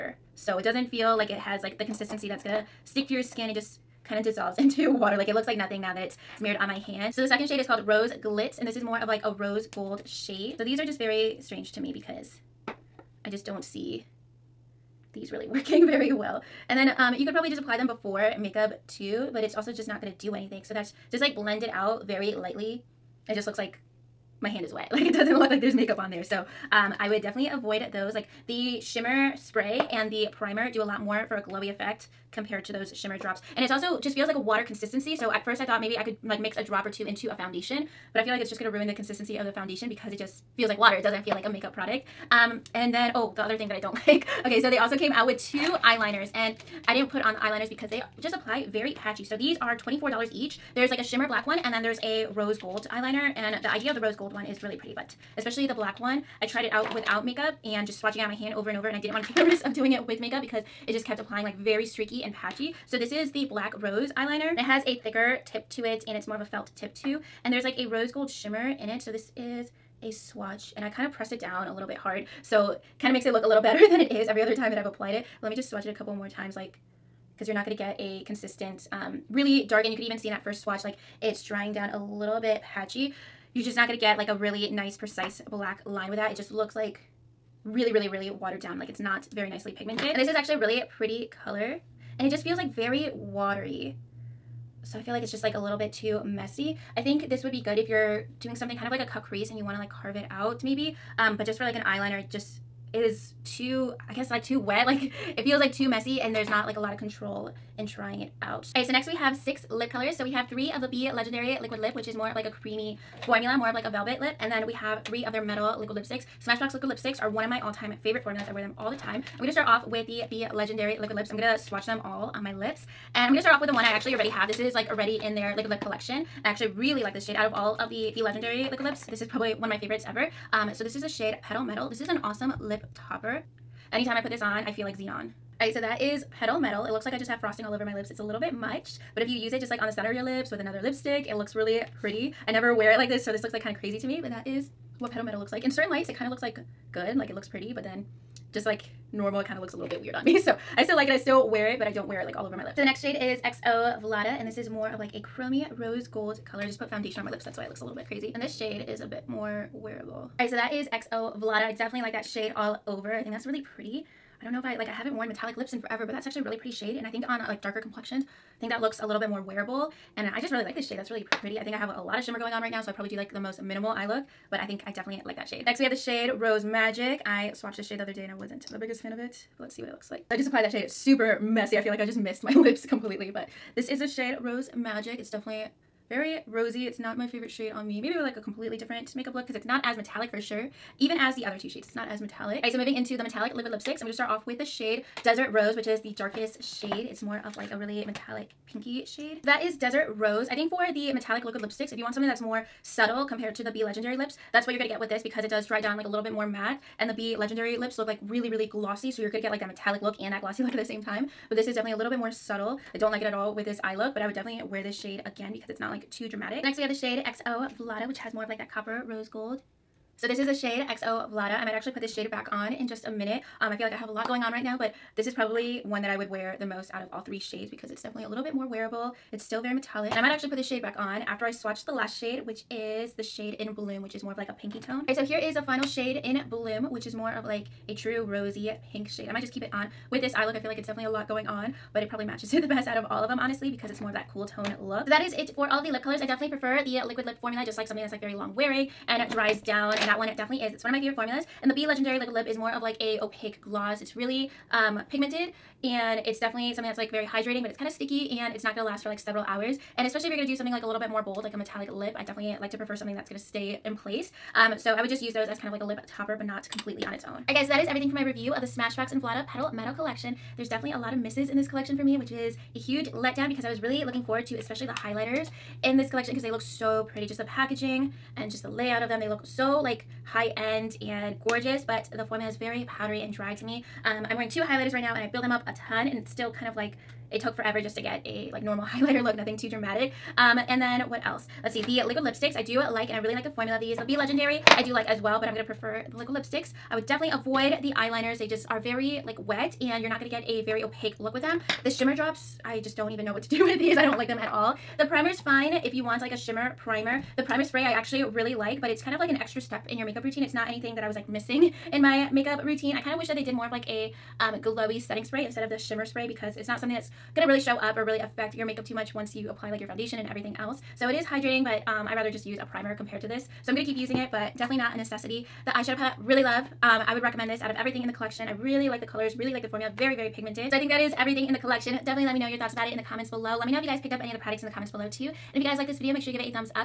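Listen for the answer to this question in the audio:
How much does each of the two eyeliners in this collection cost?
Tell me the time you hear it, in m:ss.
0:49.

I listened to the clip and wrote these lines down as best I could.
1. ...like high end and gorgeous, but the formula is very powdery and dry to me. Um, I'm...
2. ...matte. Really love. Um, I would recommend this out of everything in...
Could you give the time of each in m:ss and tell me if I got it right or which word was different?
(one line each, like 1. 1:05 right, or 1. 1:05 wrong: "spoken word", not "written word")
1. 4:39 right
2. 5:25 wrong: "palette", not "matte".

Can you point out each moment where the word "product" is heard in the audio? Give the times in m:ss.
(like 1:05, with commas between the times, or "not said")
0:41, 5:34.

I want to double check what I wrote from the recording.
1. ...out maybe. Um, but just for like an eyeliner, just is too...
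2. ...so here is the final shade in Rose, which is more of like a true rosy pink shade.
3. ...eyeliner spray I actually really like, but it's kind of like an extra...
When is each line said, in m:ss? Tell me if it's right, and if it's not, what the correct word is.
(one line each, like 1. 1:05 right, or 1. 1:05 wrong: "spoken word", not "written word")
1. 1:40 right
2. 3:55 wrong: "Bloom", not "Rose"
3. 5:07 wrong: "primer", not "eyeliner".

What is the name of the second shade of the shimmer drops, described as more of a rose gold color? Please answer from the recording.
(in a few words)
Rose Glitz.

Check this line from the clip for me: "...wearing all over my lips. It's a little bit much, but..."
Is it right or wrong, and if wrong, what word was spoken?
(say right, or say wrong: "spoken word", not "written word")
wrong: "frosting", not "wearing".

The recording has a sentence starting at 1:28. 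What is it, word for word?
Like it's not very nicely pigmented.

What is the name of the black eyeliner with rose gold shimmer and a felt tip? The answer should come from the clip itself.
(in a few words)
Black Rose.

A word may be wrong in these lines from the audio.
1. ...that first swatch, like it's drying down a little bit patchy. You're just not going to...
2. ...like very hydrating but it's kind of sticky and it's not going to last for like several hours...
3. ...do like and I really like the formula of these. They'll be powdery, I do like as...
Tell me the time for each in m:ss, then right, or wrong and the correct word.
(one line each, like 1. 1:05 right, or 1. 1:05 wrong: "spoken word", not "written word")
1. 1:20 right
2. 4:16 right
3. 4:52 wrong: "legendary", not "powdery".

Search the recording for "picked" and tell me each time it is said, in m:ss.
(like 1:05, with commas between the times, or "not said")
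5:33.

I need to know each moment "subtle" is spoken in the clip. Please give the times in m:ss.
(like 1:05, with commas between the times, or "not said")
3:22, 3:32.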